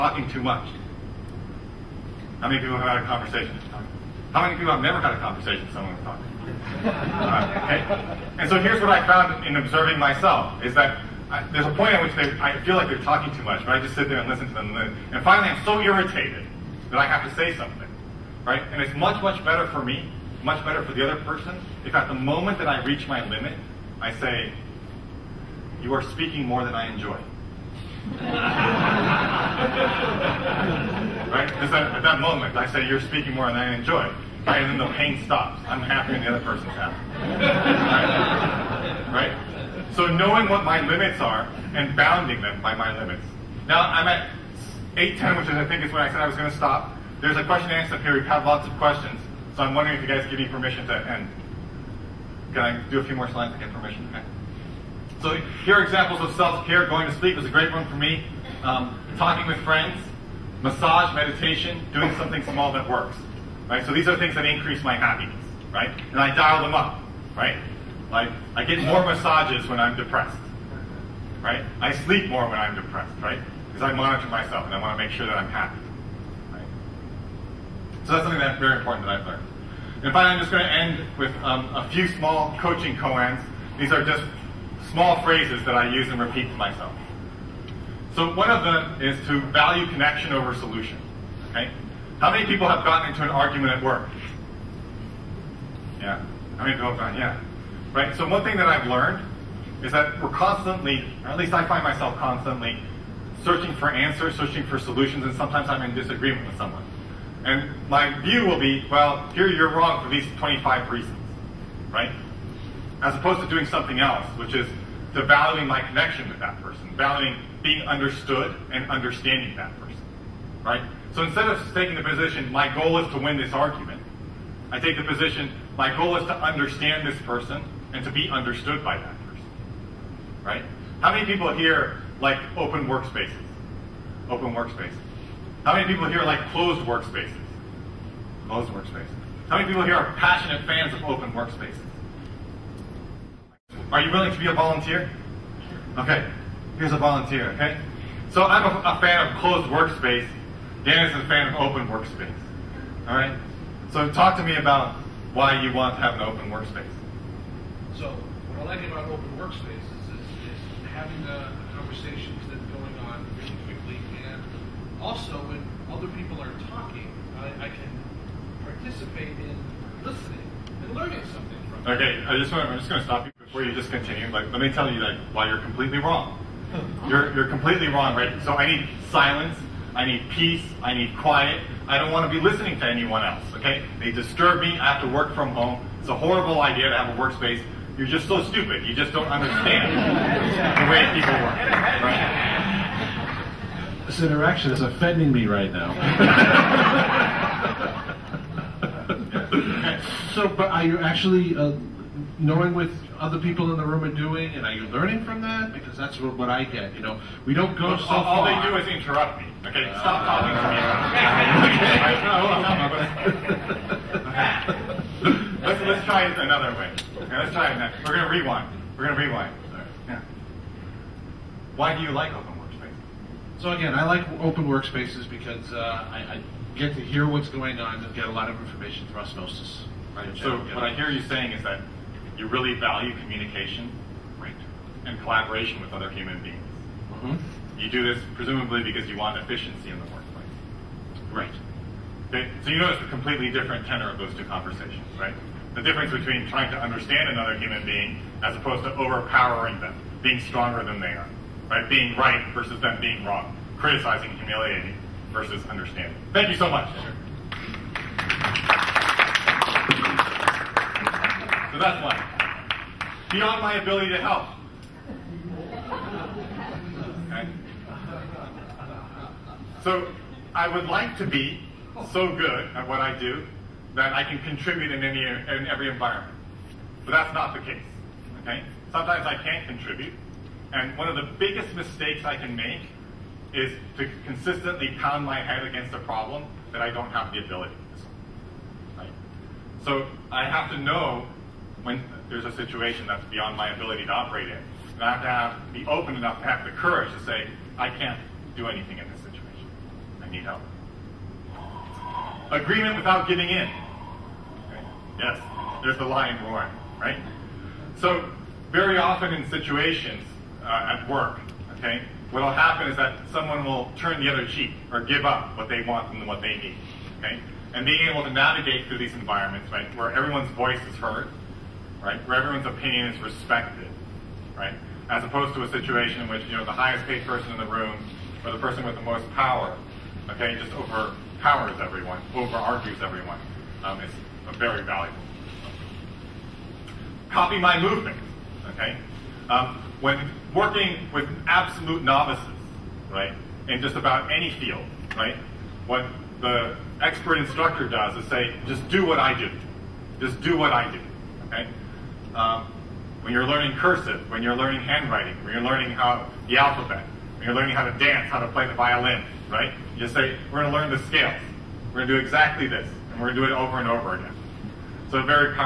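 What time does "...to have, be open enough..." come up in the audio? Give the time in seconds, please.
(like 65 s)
295 s.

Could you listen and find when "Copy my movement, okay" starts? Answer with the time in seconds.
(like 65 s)
337 s.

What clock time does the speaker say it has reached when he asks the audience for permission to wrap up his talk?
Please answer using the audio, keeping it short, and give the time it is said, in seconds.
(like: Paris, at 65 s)
8:10, at 44 s.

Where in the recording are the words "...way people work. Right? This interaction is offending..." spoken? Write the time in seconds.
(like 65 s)
190 s.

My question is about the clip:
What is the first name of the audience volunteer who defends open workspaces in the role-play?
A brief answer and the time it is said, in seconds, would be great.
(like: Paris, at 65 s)
Dan, at 150 s.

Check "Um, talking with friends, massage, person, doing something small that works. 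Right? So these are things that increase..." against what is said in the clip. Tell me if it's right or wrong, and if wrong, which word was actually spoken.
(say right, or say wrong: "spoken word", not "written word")
wrong: "meditation", not "person".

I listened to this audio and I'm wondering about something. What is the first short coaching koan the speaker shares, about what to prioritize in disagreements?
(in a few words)
Connection over solution.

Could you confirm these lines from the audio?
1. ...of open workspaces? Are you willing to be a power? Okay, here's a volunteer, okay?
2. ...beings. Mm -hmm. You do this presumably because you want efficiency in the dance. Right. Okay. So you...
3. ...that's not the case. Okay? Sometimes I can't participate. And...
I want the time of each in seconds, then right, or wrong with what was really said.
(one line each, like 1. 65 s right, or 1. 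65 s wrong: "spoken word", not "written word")
1. 140 s wrong: "volunteer", not "power"
2. 236 s wrong: "workplace", not "dance"
3. 277 s wrong: "contribute", not "participate".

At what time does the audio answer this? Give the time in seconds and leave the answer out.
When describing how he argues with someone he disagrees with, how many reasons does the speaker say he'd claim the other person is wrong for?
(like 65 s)
110 s.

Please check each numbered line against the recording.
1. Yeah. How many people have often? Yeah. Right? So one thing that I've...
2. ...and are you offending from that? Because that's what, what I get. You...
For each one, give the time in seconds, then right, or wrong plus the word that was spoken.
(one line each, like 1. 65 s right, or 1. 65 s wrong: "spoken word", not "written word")
1. 96 s wrong: "gotten", not "often"
2. 204 s wrong: "learning", not "offending".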